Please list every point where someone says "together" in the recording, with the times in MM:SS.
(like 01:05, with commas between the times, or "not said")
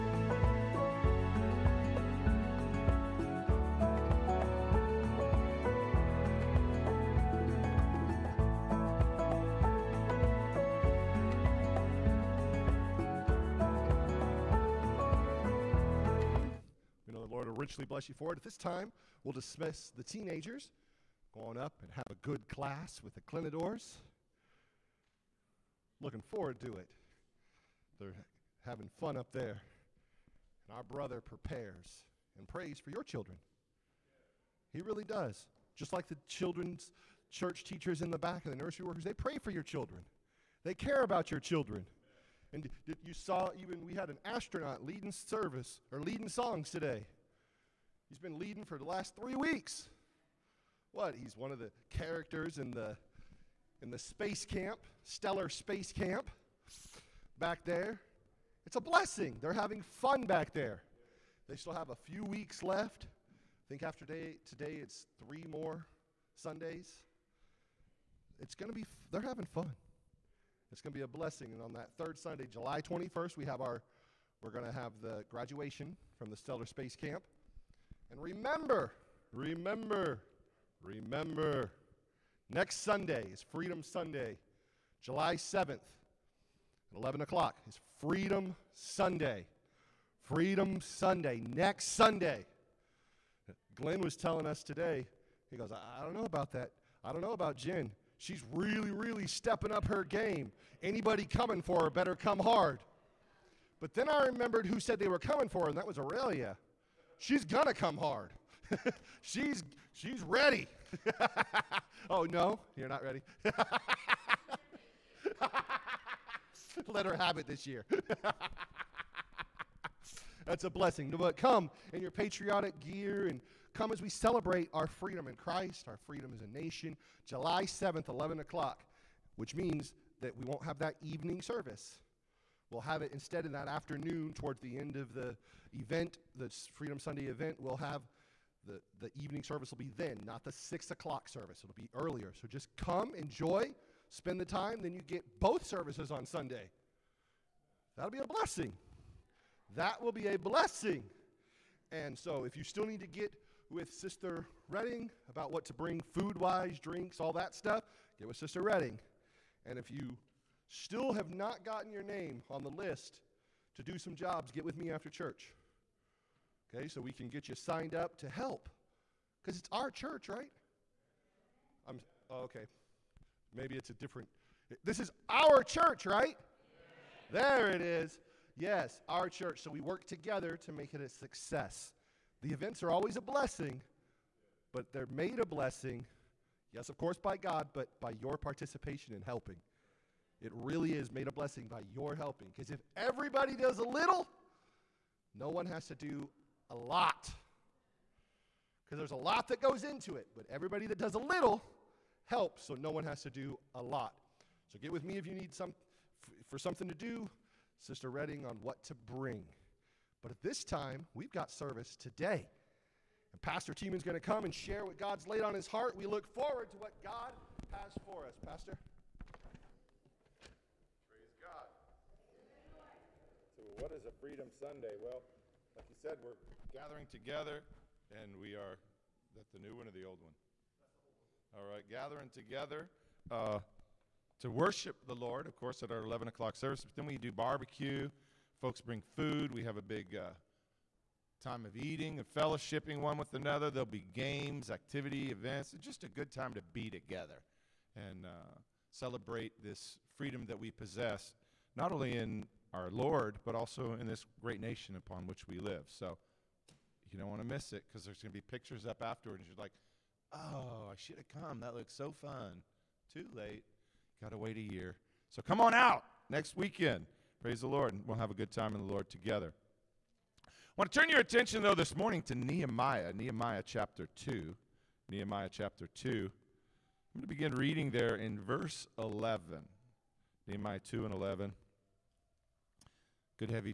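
03:00, 03:47, 03:52, 04:06, 04:29.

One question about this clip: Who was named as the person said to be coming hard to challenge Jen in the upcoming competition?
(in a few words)
Aurelia.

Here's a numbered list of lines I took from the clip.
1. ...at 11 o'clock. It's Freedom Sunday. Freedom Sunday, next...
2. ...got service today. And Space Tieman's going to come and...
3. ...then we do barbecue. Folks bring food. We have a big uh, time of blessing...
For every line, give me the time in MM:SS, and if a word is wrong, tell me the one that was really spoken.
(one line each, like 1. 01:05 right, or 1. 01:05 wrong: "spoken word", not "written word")
1. 01:25 right
2. 03:31 wrong: "Pastor", not "Space"
3. 03:56 wrong: "eating", not "blessing".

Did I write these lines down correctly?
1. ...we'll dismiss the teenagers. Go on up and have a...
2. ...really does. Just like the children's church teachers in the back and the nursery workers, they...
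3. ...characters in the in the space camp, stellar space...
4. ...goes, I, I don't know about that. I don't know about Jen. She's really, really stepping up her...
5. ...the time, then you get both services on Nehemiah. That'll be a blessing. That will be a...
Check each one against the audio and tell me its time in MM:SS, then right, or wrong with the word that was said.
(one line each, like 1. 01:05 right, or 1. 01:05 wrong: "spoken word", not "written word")
1. 00:19 right
2. 00:34 right
3. 00:51 right
4. 01:35 right
5. 02:24 wrong: "Sunday", not "Nehemiah".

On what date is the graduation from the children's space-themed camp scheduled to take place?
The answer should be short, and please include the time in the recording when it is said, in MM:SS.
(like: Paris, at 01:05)
July 21st, at 01:12.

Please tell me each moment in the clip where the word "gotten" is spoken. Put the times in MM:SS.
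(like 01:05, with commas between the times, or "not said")
02:41.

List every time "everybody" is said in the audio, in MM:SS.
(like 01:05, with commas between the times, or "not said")
03:12, 03:20.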